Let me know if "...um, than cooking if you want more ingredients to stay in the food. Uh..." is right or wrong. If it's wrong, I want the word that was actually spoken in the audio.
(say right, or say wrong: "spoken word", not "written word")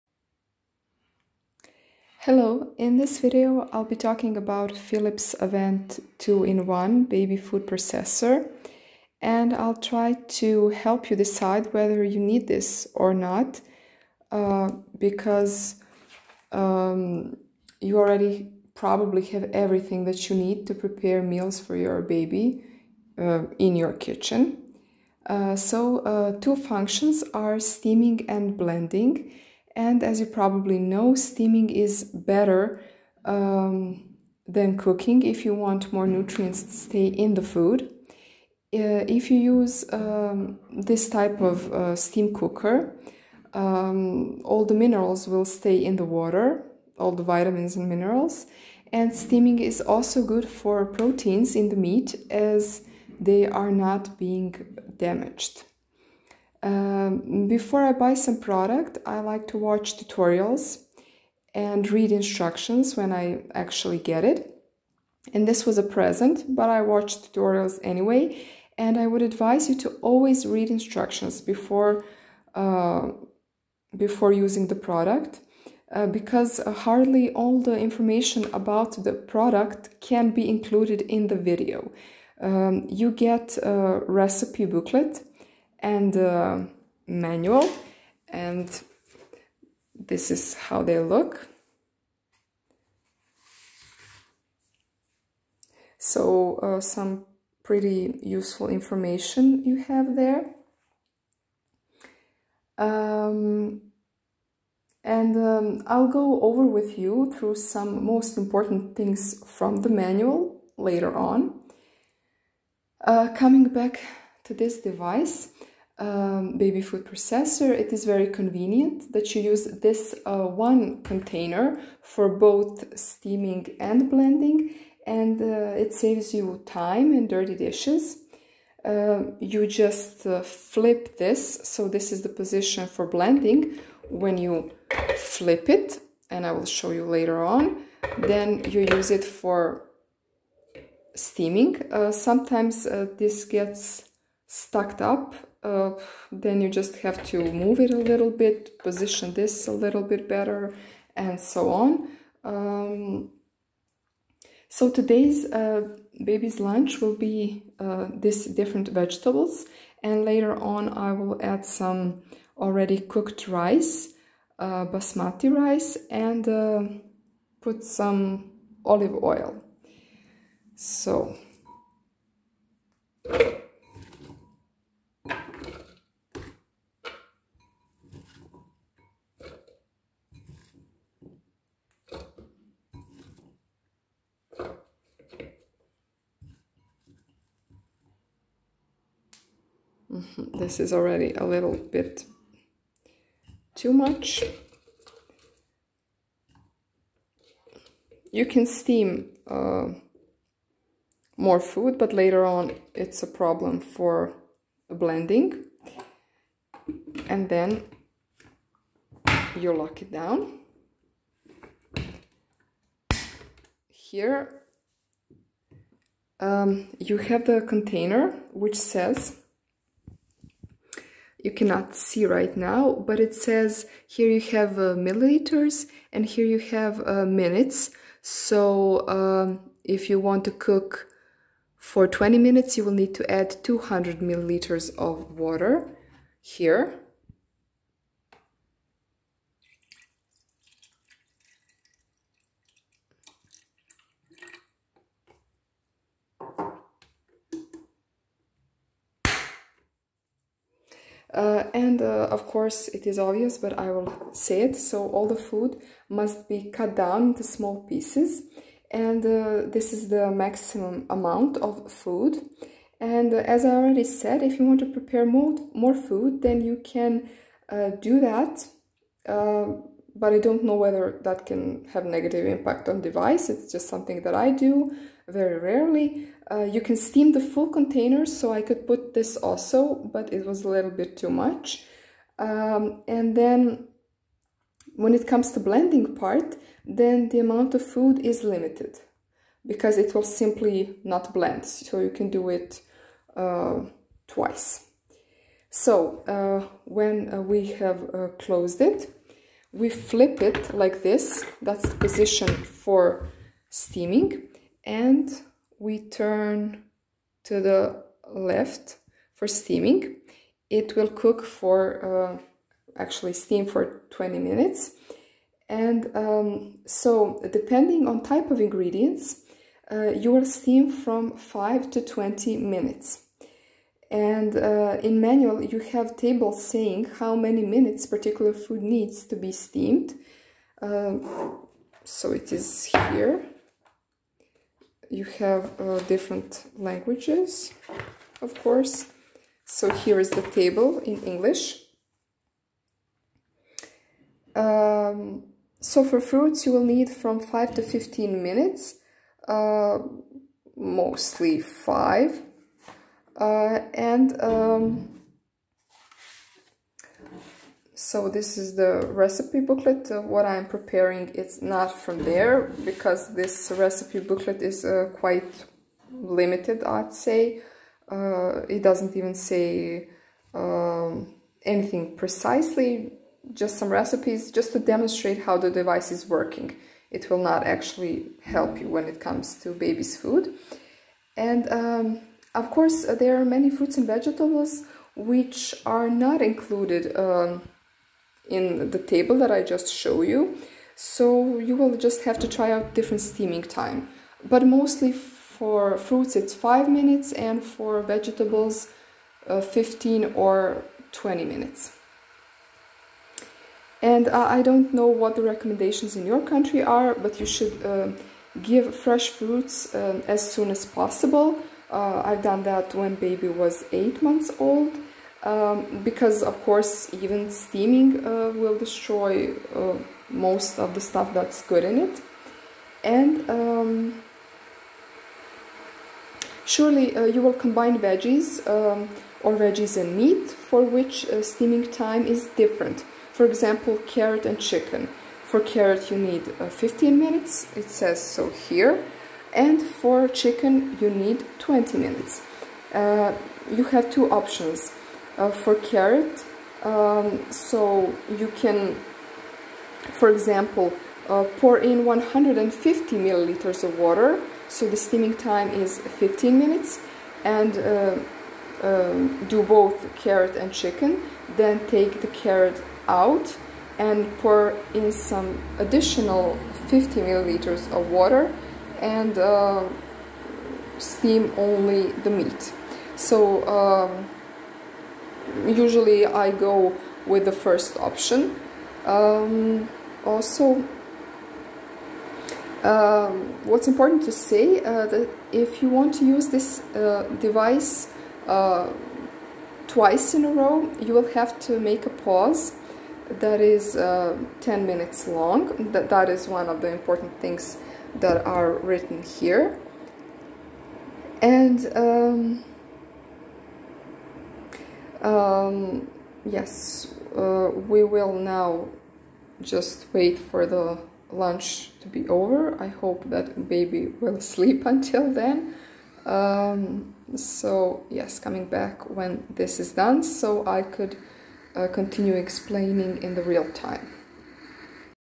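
wrong: "nutrients", not "ingredients".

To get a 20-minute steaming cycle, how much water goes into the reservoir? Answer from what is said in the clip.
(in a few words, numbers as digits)
200 milliliters.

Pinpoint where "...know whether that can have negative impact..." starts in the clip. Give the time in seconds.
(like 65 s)
270 s.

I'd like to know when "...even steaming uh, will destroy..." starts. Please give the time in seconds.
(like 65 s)
417 s.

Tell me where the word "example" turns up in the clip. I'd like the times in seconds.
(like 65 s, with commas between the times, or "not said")
433 s, 450 s.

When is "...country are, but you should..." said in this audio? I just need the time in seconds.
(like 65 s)
406 s.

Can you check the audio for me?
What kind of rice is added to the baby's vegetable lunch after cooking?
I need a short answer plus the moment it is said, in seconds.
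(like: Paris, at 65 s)
Basmati rice, at 164 s.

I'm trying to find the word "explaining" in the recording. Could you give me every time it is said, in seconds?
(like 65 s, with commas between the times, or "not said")
522 s.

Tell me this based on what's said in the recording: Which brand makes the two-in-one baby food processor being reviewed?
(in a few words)
Philips Avent.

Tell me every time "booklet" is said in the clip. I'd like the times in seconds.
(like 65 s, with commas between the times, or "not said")
84 s, 359 s, 364 s.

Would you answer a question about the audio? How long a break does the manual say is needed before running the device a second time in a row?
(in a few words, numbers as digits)
10 minutes.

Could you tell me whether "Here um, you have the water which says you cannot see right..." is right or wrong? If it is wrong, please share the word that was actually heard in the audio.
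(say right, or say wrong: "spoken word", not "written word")
wrong: "container", not "water".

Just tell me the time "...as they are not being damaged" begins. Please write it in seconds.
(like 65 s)
52 s.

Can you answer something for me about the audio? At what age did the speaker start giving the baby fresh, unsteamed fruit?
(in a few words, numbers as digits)
8 months.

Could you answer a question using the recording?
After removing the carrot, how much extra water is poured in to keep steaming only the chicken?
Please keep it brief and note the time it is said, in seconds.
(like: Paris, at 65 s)
50 milliliters, at 466 s.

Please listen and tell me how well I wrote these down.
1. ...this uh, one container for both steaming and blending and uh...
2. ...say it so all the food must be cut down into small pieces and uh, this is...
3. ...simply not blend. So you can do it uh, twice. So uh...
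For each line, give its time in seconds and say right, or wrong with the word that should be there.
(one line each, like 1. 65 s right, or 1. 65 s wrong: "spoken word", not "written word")
1. 119 s right
2. 254 s right
3. 290 s right.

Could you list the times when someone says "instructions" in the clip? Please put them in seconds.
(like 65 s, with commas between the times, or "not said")
62 s, 70 s.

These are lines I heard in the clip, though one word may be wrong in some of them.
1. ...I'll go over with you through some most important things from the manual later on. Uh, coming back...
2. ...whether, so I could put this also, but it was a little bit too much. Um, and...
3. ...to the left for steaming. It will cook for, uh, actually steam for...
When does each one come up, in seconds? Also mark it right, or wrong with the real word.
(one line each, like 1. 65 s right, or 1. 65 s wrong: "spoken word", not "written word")
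1. 105 s right
2. 277 s wrong: "container", not "whether"
3. 307 s right.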